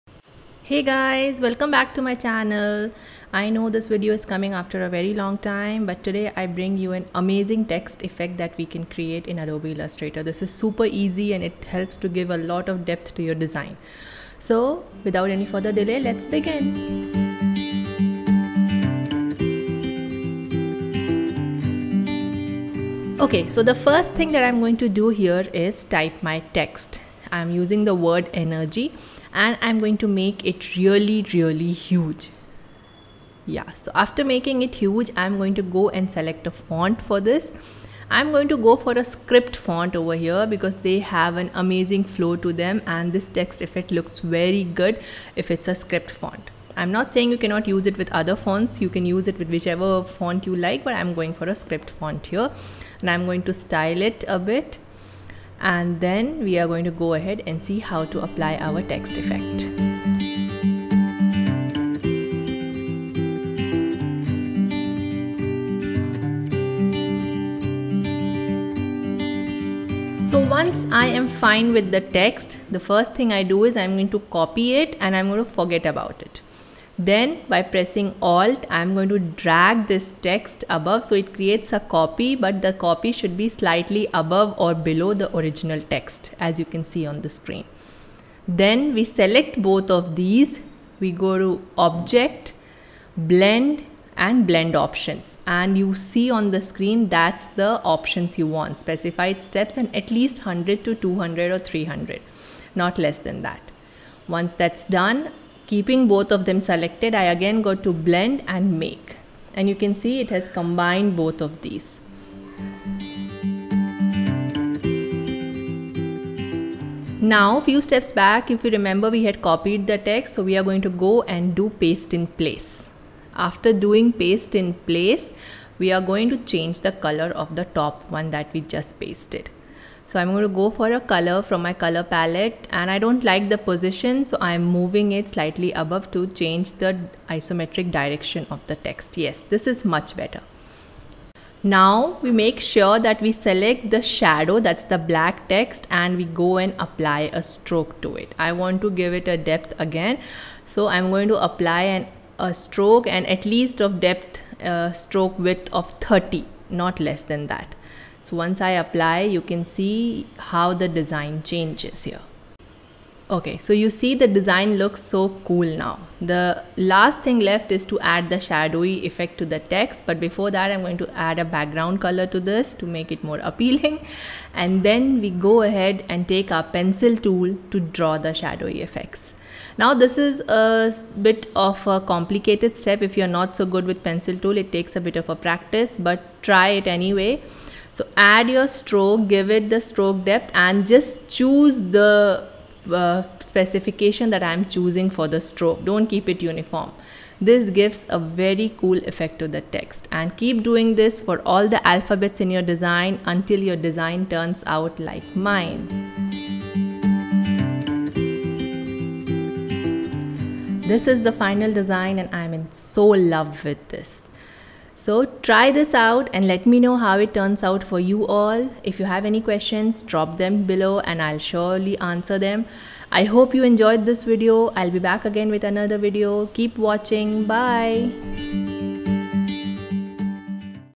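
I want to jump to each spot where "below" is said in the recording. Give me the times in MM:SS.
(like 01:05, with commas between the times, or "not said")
01:24, 03:40.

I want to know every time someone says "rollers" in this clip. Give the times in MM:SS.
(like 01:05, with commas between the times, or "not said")
not said.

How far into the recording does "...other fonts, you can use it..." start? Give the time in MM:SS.
00:48.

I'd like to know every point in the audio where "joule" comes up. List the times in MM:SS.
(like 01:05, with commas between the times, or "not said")
not said.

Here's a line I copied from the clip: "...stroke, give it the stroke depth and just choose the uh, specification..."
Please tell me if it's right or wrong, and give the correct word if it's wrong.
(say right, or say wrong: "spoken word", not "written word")
right.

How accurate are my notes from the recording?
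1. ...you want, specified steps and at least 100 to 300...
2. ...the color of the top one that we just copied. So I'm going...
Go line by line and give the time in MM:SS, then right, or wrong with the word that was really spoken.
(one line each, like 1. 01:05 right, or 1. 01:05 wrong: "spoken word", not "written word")
1. 01:38 wrong: "200", not "300"
2. 02:06 wrong: "pasted", not "copied".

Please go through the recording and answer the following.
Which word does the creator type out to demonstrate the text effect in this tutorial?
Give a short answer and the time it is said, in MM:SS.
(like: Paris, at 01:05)
energy, at 00:28.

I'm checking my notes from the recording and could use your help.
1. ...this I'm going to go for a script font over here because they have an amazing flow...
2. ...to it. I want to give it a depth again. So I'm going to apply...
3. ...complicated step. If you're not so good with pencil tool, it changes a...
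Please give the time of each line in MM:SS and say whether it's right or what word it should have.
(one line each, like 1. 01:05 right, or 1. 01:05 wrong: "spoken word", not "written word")
1. 00:37 right
2. 02:28 right
3. 03:02 wrong: "takes", not "changes".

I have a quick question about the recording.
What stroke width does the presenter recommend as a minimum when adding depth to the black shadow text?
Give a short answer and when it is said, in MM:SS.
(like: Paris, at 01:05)
30, at 02:36.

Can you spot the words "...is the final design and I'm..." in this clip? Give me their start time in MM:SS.
03:31.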